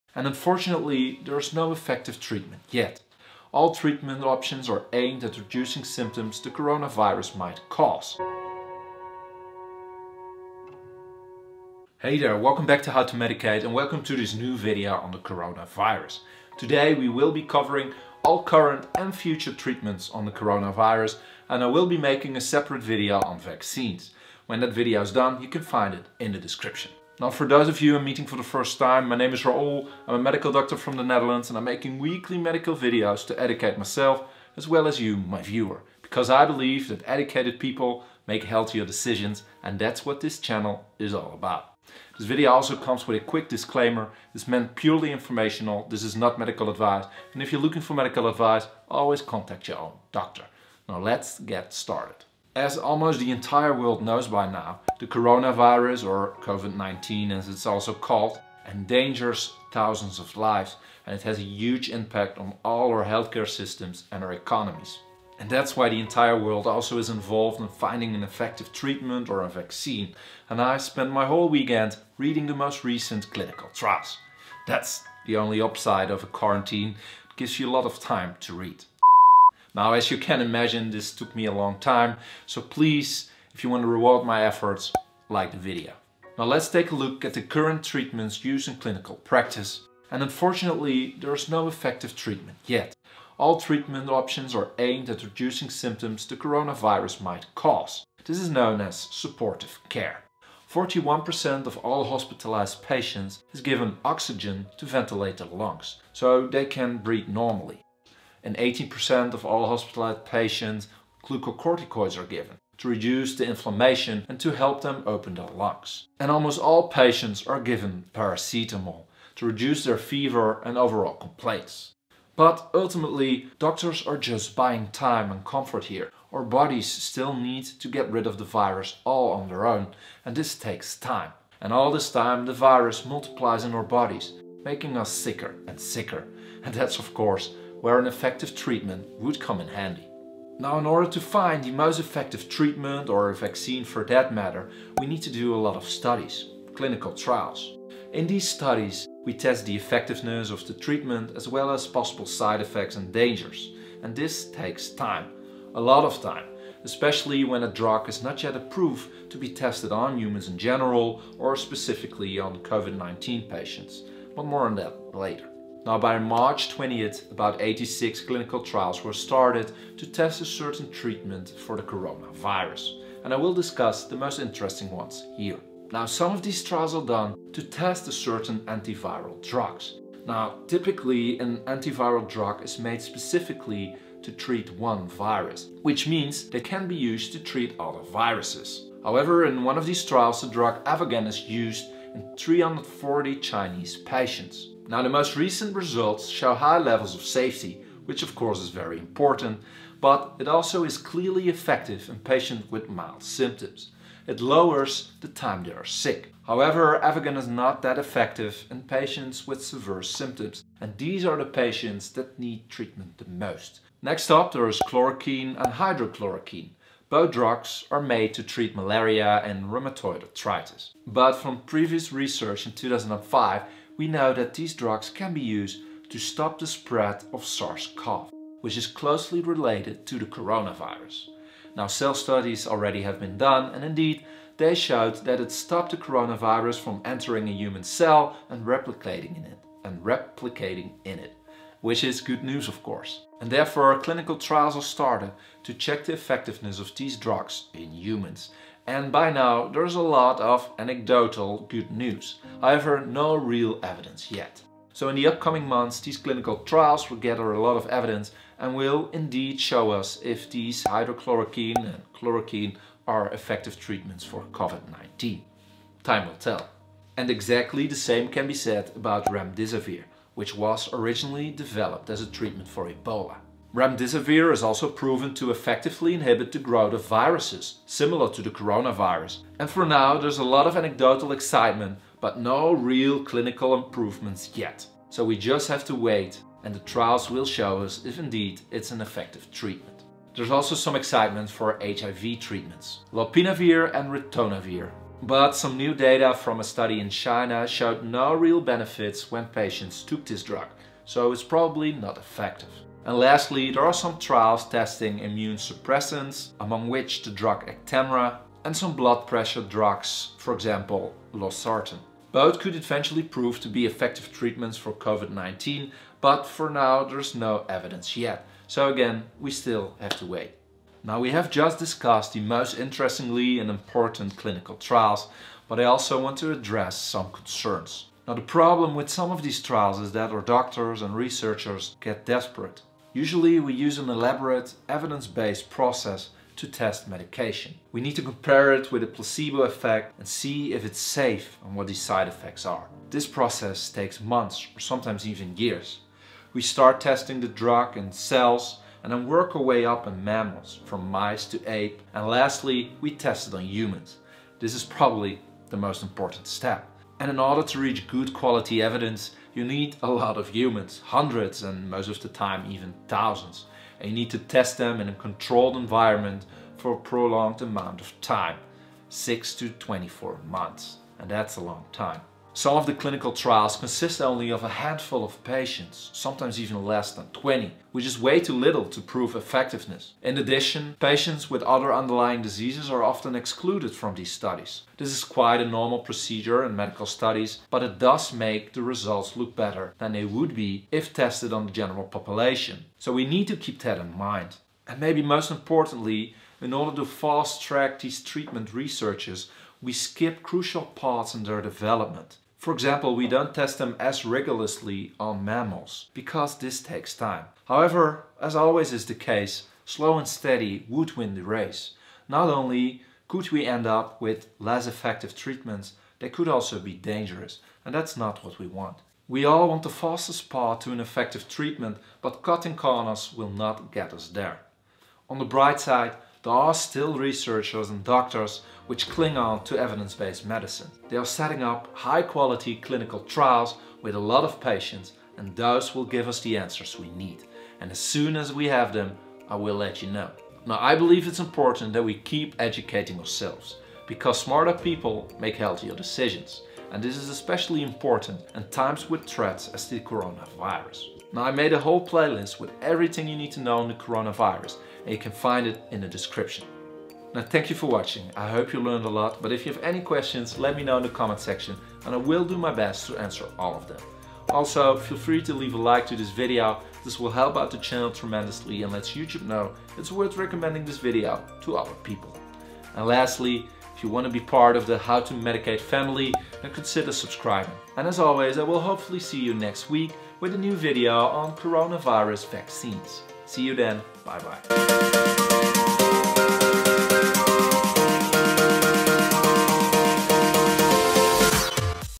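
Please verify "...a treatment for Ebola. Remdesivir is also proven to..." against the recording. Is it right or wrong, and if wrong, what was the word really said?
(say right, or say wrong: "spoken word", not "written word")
right.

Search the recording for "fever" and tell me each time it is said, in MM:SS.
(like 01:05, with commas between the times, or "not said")
01:59.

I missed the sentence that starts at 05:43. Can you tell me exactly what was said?
This process takes months or sometimes even years.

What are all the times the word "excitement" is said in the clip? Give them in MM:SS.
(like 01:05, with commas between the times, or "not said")
04:41, 04:50.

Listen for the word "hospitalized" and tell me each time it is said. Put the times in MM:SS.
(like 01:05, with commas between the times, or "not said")
01:42, 01:49.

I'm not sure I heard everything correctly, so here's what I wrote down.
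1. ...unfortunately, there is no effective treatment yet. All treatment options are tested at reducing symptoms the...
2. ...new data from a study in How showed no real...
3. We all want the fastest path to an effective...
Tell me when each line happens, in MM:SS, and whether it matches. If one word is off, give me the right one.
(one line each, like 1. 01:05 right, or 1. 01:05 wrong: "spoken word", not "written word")
1. 01:30 wrong: "aimed", not "tested"
2. 04:55 wrong: "China", not "How"
3. 06:59 right.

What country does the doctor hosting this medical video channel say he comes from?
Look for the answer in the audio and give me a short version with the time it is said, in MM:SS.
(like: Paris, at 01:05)
the Netherlands, at 00:30.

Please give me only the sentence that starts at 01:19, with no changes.
Now, as you can imagine, this took me a long time.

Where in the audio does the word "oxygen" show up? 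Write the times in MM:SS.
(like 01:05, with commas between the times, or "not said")
01:44.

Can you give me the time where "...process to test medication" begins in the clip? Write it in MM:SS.
05:35.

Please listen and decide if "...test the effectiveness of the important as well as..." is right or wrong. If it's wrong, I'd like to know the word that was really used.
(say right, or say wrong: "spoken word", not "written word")
wrong: "treatment", not "important".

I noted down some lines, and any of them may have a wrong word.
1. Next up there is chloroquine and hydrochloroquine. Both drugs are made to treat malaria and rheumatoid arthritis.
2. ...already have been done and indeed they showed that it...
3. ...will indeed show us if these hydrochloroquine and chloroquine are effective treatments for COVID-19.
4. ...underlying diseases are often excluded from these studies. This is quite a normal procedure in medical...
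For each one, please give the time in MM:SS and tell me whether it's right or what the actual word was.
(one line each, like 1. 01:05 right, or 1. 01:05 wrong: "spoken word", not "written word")
1. 03:34 right
2. 03:52 right
3. 04:18 right
4. 06:21 right.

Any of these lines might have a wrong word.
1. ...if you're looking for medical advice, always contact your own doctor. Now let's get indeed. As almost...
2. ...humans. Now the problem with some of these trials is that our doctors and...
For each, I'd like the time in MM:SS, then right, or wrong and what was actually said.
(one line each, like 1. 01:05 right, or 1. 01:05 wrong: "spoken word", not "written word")
1. 00:47 wrong: "started", not "indeed"
2. 05:27 wrong: "concerns", not "humans".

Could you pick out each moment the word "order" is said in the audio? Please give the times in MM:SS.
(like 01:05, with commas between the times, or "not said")
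02:20, 05:57, 06:36.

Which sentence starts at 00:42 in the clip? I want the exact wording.
This video also comes with a quick disclaimer.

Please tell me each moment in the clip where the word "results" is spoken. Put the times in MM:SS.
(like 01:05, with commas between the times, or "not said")
03:15, 06:28.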